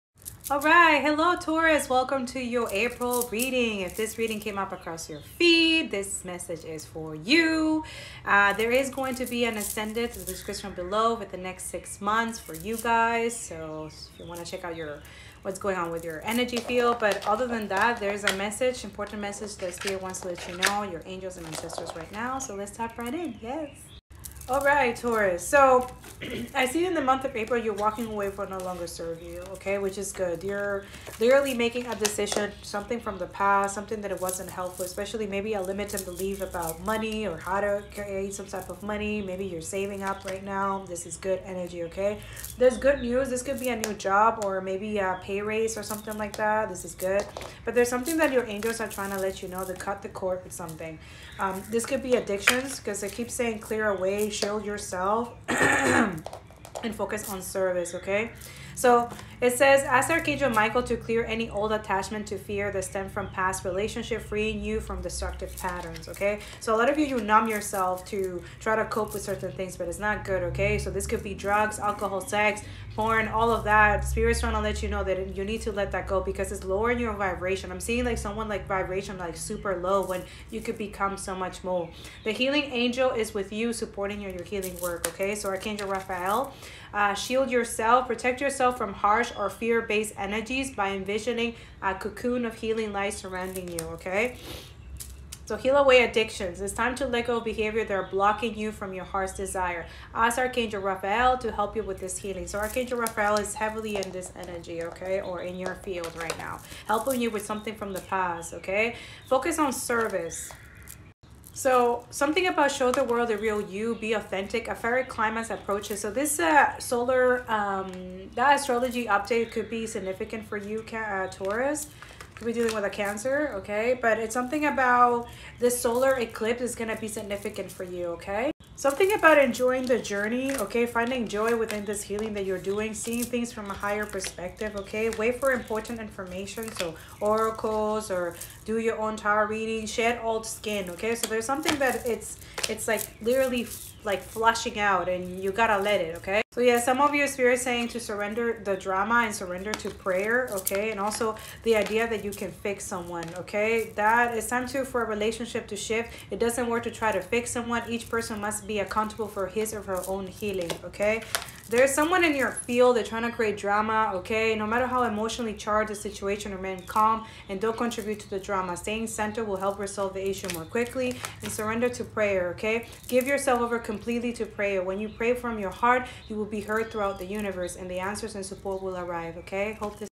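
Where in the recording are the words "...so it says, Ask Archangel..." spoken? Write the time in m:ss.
0:58.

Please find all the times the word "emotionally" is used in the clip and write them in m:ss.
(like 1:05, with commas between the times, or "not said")
2:45.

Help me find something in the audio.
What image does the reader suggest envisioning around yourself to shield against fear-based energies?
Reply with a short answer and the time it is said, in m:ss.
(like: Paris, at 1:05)
A cocoon of healing light, at 1:31.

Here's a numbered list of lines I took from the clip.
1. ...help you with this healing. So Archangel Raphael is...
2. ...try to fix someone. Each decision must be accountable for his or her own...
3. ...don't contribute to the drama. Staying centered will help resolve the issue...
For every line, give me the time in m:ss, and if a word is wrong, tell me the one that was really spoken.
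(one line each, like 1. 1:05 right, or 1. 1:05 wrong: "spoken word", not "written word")
1. 1:41 right
2. 2:36 wrong: "person", not "decision"
3. 2:47 right.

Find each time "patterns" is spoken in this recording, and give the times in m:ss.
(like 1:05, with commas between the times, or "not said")
1:05.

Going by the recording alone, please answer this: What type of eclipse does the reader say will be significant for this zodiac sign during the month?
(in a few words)
Solar eclipse.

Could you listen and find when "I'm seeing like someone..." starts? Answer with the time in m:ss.
1:17.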